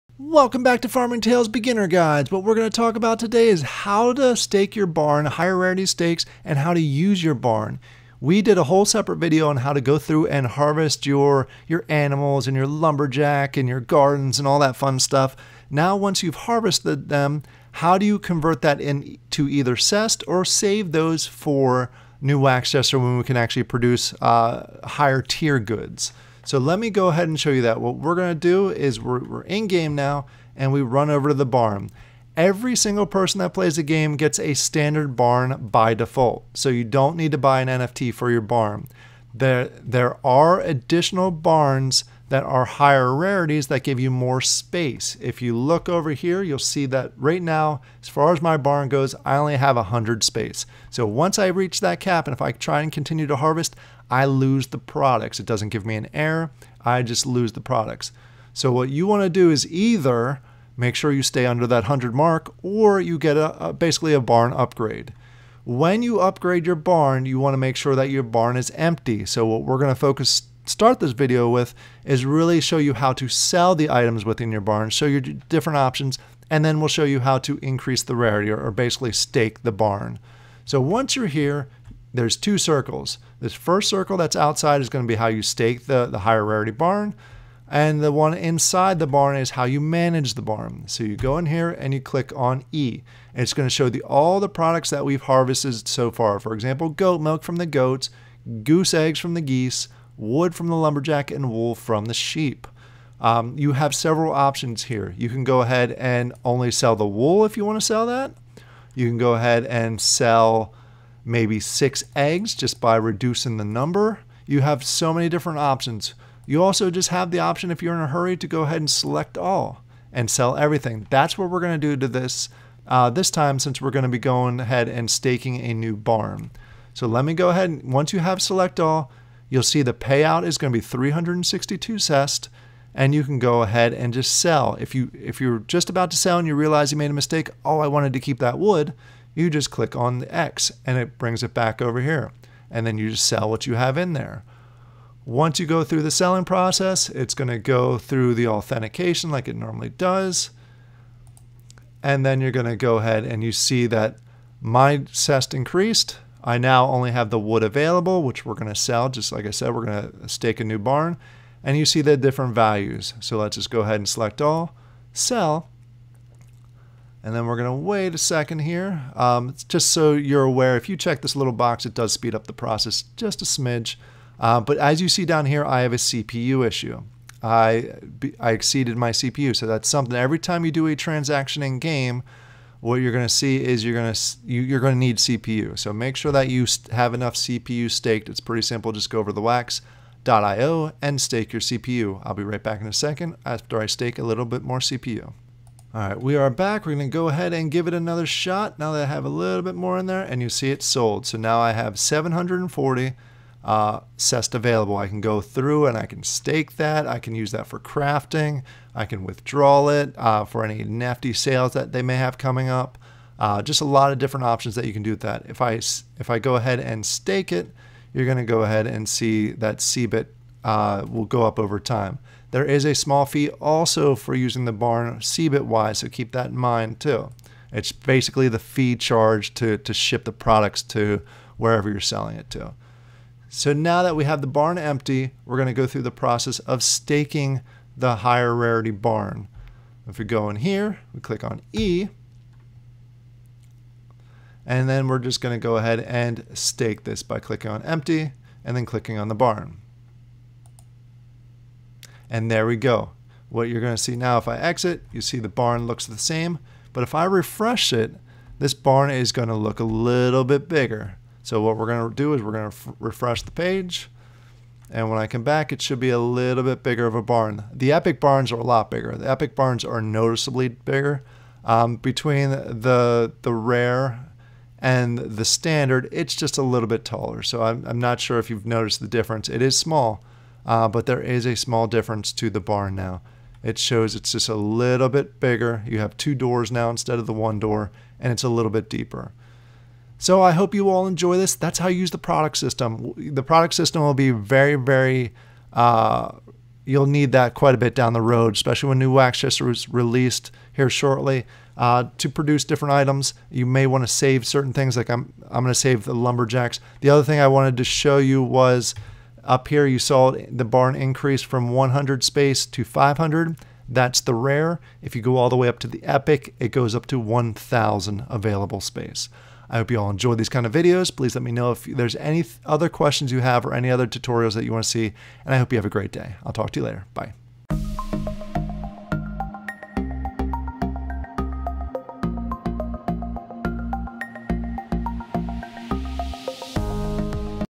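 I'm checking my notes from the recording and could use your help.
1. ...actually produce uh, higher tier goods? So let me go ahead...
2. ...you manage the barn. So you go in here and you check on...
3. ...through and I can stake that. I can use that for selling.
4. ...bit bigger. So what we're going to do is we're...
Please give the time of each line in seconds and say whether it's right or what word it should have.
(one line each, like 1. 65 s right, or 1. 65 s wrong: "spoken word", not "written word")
1. 23 s right
2. 89 s wrong: "click", not "check"
3. 205 s wrong: "crafting", not "selling"
4. 260 s right.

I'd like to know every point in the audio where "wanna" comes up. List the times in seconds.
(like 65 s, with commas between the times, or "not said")
59 s, 67 s.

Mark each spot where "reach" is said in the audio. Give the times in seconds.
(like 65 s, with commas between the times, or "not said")
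51 s.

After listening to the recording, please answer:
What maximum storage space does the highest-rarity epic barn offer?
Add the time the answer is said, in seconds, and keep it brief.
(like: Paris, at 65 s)
1,000, at 317 s.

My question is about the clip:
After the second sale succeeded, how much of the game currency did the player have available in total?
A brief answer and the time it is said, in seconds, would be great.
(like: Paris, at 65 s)
740, at 201 s.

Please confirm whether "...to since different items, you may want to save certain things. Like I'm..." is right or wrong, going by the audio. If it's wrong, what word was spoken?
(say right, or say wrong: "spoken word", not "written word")
wrong: "produce", not "since".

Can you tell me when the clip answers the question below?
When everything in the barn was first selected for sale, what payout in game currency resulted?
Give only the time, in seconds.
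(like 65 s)
130 s.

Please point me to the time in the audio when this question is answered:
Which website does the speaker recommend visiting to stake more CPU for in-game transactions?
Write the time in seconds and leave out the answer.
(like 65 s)
189 s.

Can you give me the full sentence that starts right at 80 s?
So once you're here, there's two circles.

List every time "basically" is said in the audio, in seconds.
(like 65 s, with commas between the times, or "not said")
63 s, 78 s, 227 s.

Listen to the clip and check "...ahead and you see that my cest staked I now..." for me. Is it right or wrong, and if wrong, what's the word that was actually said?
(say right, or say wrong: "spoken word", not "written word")
wrong: "increased", not "staked".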